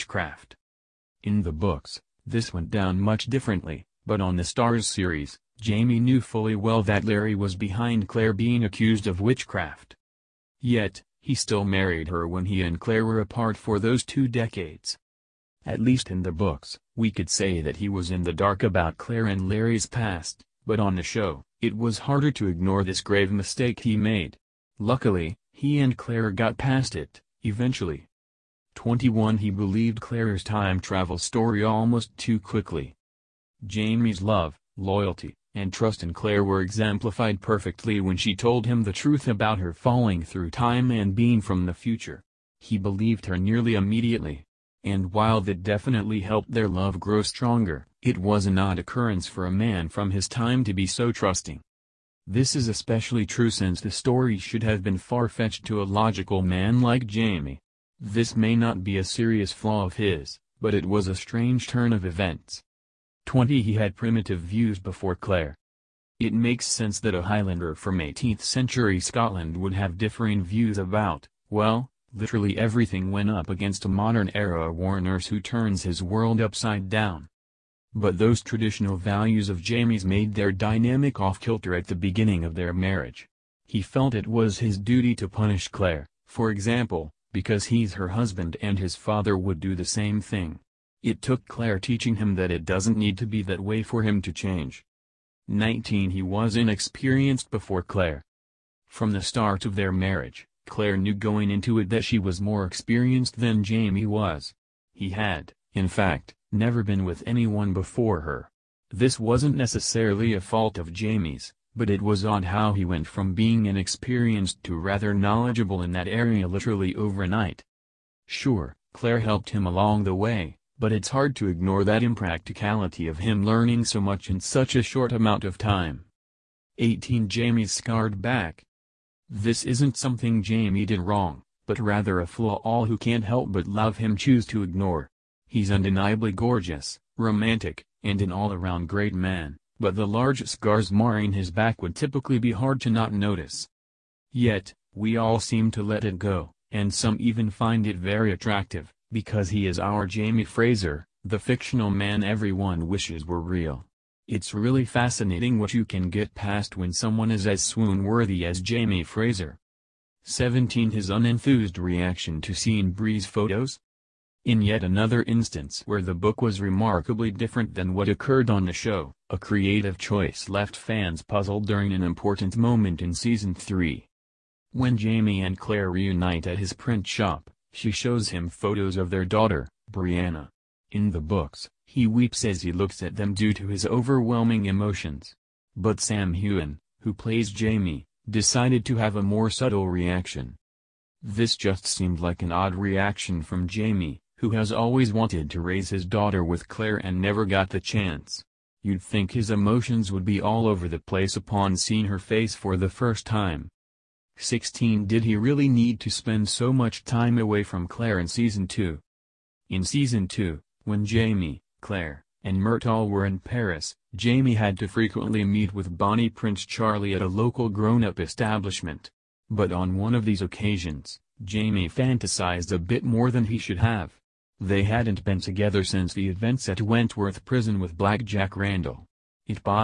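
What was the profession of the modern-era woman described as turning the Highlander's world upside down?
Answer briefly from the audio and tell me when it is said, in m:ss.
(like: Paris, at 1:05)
War nurse, at 1:14.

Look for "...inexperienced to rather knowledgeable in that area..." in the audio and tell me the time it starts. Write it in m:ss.
1:53.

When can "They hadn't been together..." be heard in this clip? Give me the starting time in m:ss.
3:44.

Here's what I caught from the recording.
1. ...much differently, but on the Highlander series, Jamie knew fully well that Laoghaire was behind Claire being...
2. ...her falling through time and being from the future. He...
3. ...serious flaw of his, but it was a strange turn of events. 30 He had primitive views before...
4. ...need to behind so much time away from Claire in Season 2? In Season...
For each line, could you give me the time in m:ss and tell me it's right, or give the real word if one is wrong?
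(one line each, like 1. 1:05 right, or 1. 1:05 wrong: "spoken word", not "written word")
1. 0:02 wrong: "Starz", not "Highlander"
2. 0:39 right
3. 0:59 wrong: "20", not "30"
4. 3:25 wrong: "spend", not "behind".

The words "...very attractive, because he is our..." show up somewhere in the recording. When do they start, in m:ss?
2:27.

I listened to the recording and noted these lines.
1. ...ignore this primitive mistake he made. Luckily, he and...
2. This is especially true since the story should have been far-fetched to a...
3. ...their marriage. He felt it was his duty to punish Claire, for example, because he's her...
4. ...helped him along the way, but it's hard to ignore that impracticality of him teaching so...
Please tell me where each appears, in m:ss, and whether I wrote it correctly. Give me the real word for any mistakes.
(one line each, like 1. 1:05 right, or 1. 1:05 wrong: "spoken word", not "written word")
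1. 0:22 wrong: "grave", not "primitive"
2. 0:52 right
3. 1:22 right
4. 1:59 wrong: "learning", not "teaching".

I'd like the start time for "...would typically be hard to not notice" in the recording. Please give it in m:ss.
2:21.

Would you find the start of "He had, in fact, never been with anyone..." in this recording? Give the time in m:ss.
1:44.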